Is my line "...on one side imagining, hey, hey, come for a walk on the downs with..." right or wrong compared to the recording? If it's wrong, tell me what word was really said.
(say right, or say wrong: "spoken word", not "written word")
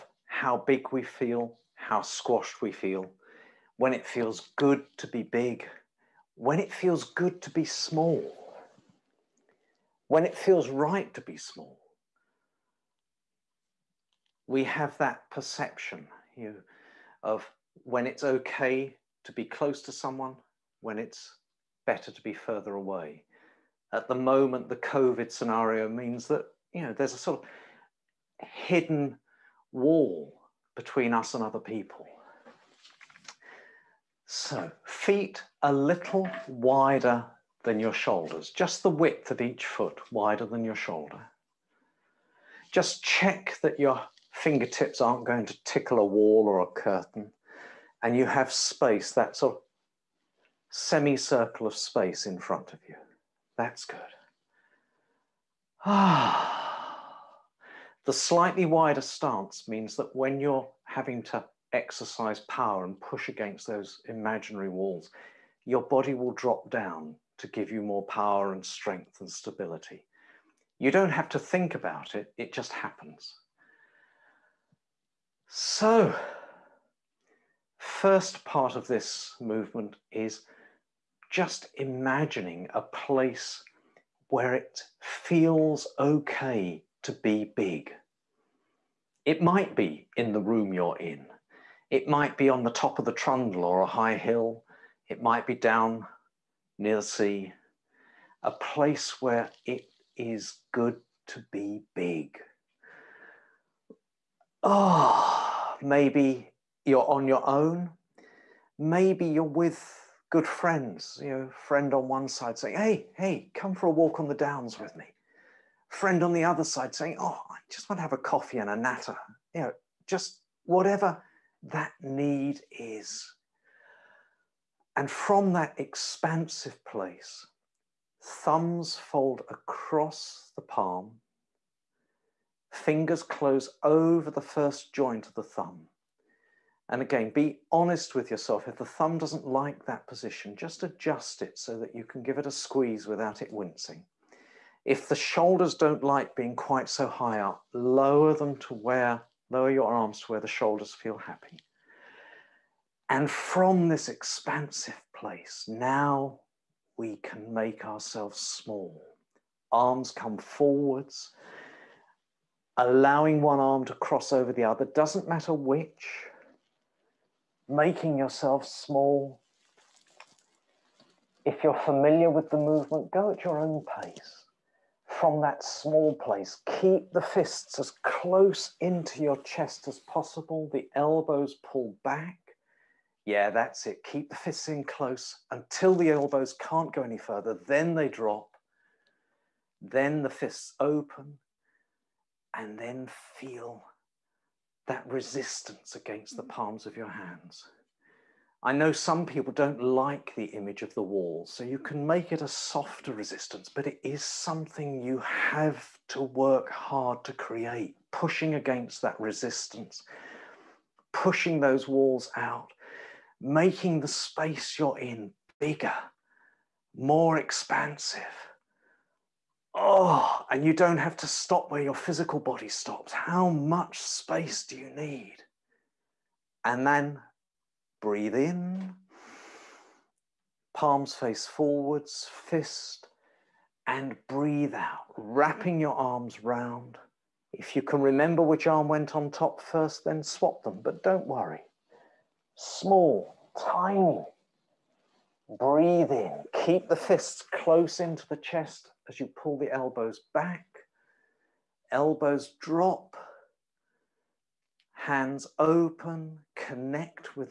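wrong: "saying", not "imagining".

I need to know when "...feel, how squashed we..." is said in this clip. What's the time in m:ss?
0:01.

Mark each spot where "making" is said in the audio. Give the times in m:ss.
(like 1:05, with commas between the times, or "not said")
2:47, 3:33.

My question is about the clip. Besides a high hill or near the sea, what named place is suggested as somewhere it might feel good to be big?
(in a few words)
the Trundle.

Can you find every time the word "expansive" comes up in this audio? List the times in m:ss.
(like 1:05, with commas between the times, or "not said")
2:05, 2:34, 3:37.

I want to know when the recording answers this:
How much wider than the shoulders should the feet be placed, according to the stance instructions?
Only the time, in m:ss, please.
0:38.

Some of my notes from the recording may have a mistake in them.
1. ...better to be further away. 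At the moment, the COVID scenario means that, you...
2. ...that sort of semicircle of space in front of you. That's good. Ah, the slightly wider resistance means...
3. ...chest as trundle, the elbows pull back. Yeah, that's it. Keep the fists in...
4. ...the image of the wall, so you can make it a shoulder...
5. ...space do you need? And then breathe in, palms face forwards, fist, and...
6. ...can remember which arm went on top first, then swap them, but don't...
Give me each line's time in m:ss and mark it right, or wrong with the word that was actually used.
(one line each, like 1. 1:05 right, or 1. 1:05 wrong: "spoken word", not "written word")
1. 0:21 right
2. 0:49 wrong: "stance", not "resistance"
3. 2:59 wrong: "possible", not "trundle"
4. 3:20 wrong: "softer", not "shoulder"
5. 3:43 right
6. 3:57 right.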